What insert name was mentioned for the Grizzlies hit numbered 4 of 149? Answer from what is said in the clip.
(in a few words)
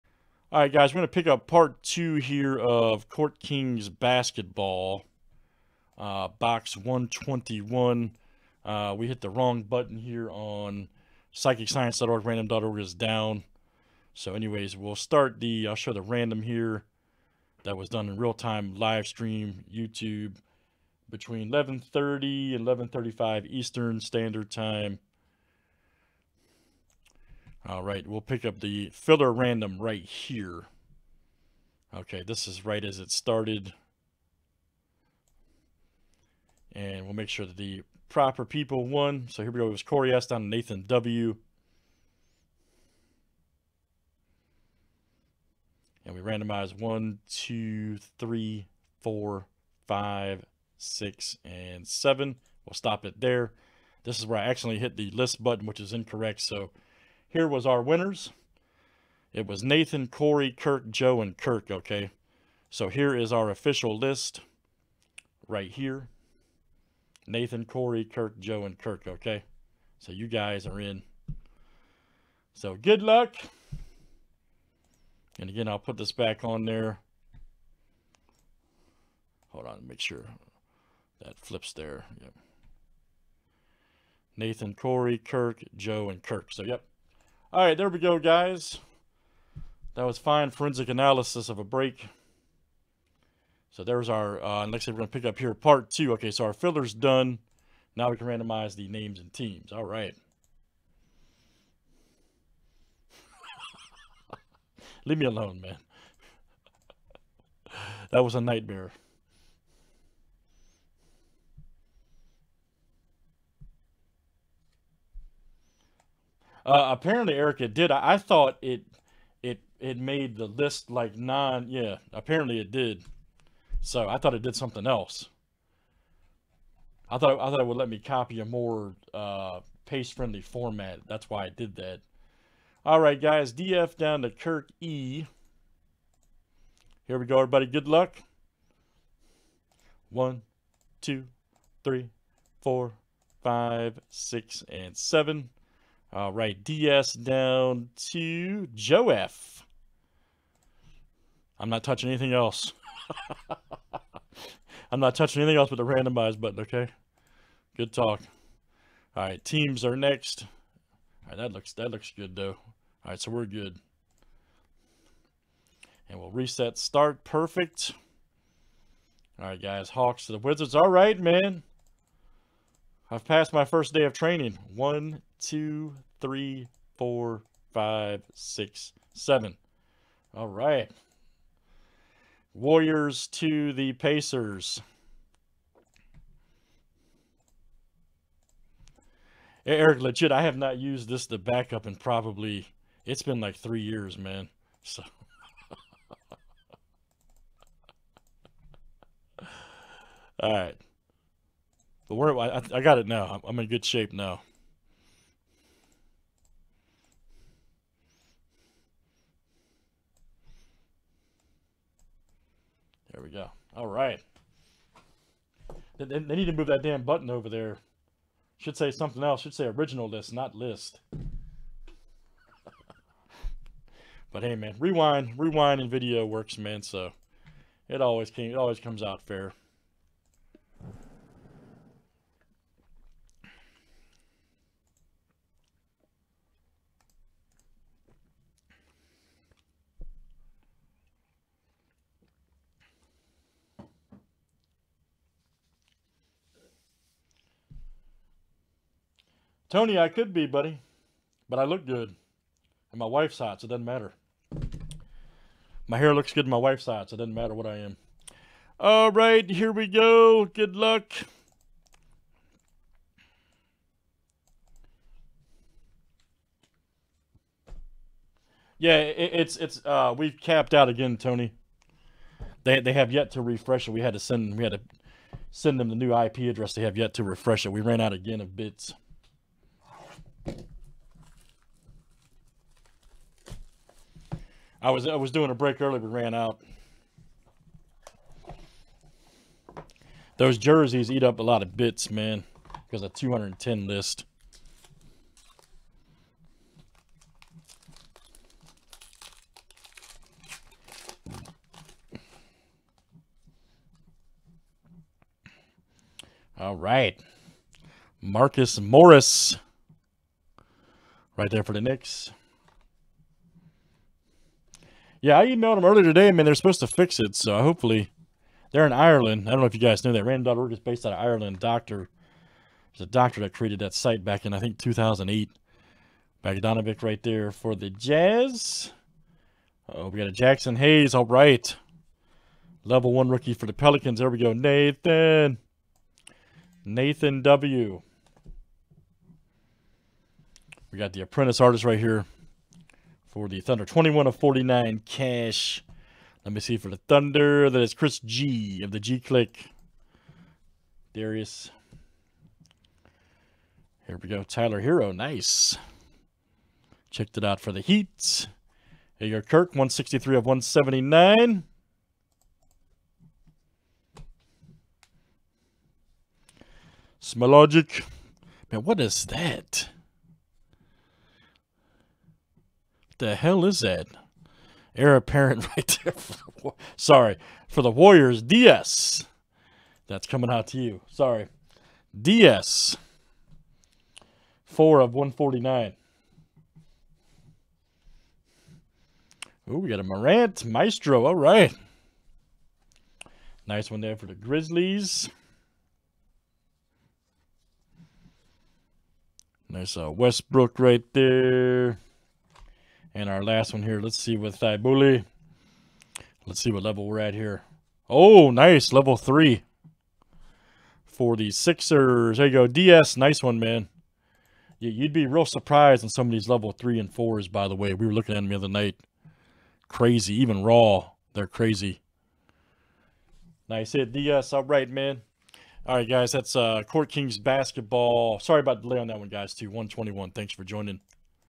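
Morant Maestro.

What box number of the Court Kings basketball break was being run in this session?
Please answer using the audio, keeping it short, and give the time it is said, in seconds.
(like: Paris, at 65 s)
121, at 6 s.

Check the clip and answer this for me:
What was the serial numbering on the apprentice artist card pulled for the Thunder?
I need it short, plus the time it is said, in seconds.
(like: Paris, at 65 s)
21 of 49, at 343 s.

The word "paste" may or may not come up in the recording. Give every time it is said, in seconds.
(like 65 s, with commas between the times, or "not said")
129 s.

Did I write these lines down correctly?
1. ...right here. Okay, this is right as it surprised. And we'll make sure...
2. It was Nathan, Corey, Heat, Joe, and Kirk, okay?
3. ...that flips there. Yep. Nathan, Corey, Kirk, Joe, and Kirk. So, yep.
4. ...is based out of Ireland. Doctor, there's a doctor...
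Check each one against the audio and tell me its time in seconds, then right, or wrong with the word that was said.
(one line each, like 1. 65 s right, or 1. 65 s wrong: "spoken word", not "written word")
1. 29 s wrong: "started", not "surprised"
2. 59 s wrong: "Kirk", not "Heat"
3. 81 s right
4. 320 s right.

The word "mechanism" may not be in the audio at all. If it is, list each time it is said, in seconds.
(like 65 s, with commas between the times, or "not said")
not said.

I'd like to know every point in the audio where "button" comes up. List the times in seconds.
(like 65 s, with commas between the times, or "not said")
9 s, 55 s, 156 s, 217 s.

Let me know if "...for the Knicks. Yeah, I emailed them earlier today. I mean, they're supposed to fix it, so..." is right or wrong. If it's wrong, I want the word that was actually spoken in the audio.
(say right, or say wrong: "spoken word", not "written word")
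right.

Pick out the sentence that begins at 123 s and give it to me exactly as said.
So I thought it did something else.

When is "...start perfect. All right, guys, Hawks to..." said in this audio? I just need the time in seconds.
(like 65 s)
166 s.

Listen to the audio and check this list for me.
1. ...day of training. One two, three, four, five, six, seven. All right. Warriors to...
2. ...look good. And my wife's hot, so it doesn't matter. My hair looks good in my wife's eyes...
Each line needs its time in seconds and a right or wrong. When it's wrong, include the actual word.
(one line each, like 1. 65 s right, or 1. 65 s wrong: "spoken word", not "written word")
1. 173 s right
2. 251 s right.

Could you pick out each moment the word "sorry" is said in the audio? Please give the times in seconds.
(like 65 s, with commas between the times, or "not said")
376 s, 381 s, 428 s.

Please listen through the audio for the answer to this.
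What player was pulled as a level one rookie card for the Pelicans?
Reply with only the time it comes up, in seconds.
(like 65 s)
330 s.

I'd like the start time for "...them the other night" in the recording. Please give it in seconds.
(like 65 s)
418 s.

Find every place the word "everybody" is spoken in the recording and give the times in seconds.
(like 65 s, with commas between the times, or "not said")
137 s.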